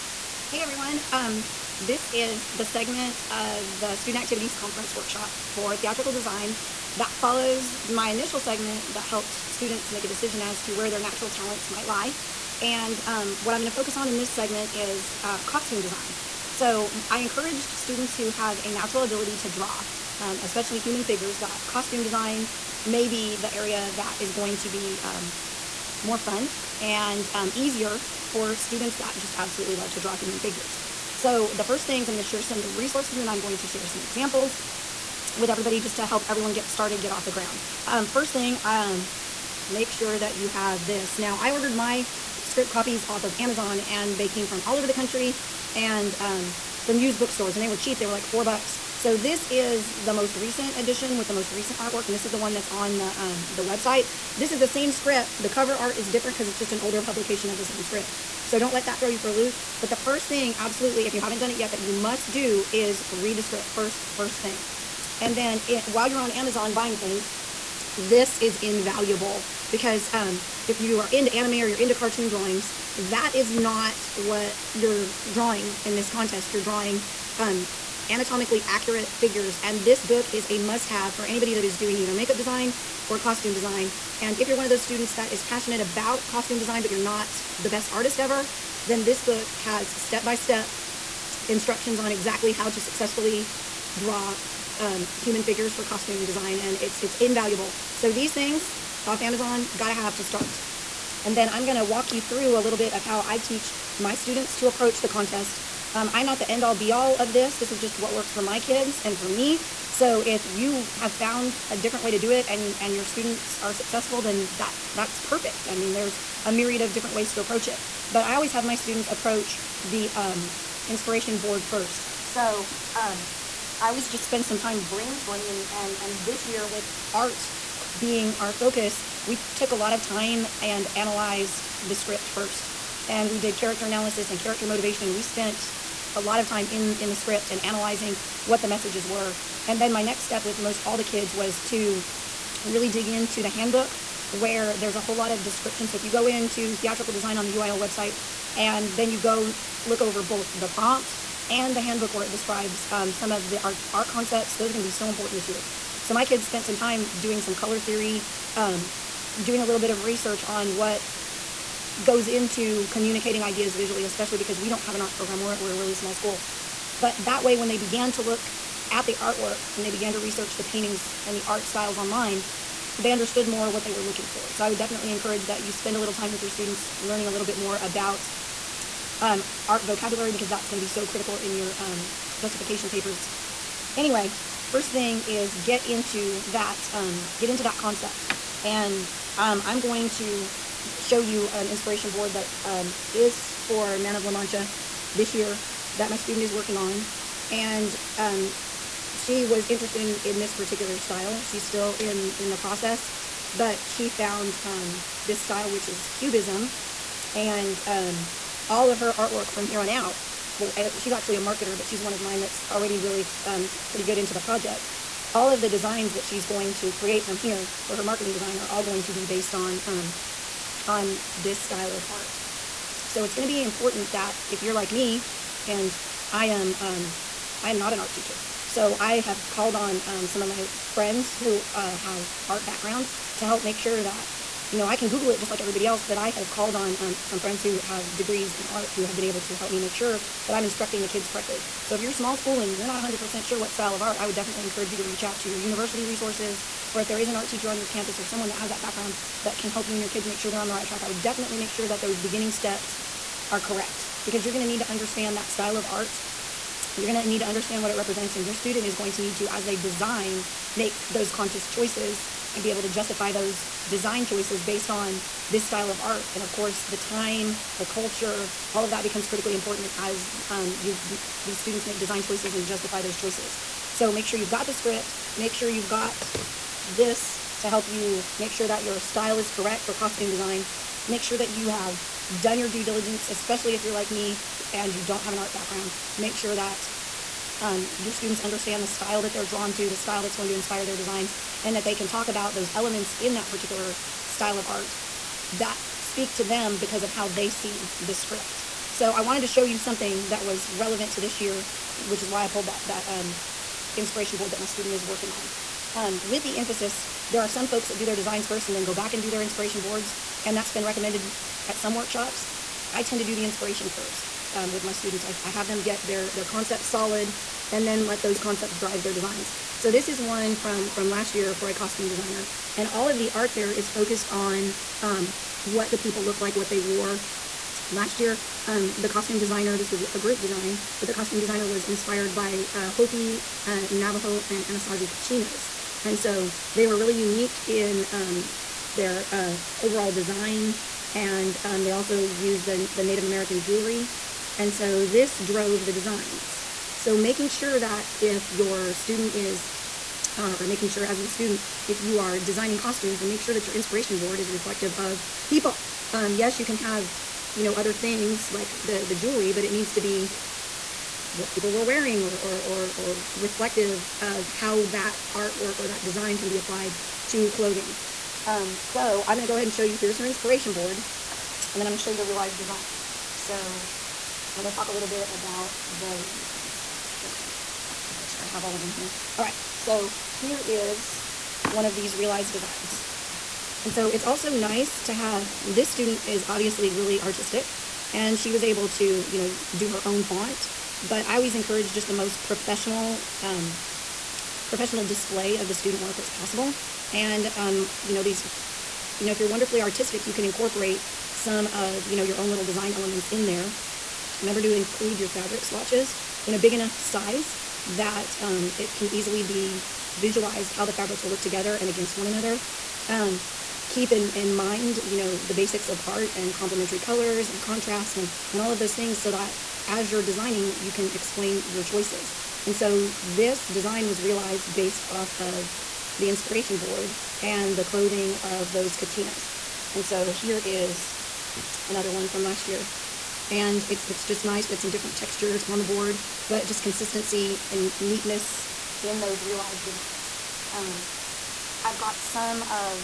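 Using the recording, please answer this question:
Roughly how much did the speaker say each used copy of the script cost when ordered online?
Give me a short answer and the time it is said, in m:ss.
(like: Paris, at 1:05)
4 dollars, at 0:48.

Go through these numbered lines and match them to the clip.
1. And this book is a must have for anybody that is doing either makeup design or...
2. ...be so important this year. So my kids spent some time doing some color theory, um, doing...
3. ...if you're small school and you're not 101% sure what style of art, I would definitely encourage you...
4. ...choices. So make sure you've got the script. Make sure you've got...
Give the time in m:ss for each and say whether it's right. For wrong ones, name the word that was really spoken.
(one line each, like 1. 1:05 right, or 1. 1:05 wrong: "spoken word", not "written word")
1. 1:19 right
2. 2:34 right
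3. 4:01 wrong: "100", not "101"
4. 4:33 right.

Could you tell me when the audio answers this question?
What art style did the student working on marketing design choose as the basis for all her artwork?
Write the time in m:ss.
3:26.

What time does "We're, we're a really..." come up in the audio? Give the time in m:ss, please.
2:45.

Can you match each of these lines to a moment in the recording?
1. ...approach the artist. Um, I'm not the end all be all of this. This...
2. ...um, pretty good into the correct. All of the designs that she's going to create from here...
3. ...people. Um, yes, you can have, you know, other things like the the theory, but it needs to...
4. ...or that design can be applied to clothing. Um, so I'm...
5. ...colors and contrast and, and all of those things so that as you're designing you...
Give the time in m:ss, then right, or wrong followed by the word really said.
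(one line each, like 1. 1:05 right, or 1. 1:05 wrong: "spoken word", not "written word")
1. 1:44 wrong: "contest", not "artist"
2. 3:33 wrong: "project", not "correct"
3. 5:55 wrong: "jewelry", not "theory"
4. 6:05 right
5. 6:56 right.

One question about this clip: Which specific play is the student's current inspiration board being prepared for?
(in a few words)
Man of La Mancha.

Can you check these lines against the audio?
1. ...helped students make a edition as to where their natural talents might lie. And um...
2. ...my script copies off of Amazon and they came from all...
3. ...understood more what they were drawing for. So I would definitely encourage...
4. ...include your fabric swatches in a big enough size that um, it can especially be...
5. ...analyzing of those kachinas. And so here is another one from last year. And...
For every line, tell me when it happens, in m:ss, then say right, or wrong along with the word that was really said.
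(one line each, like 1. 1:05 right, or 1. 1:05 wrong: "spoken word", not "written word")
1. 0:09 wrong: "decision", not "edition"
2. 0:41 right
3. 2:53 wrong: "looking", not "drawing"
4. 6:44 wrong: "easily", not "especially"
5. 7:07 wrong: "clothing", not "analyzing".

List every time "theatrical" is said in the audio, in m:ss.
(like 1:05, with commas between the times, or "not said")
0:05, 2:26.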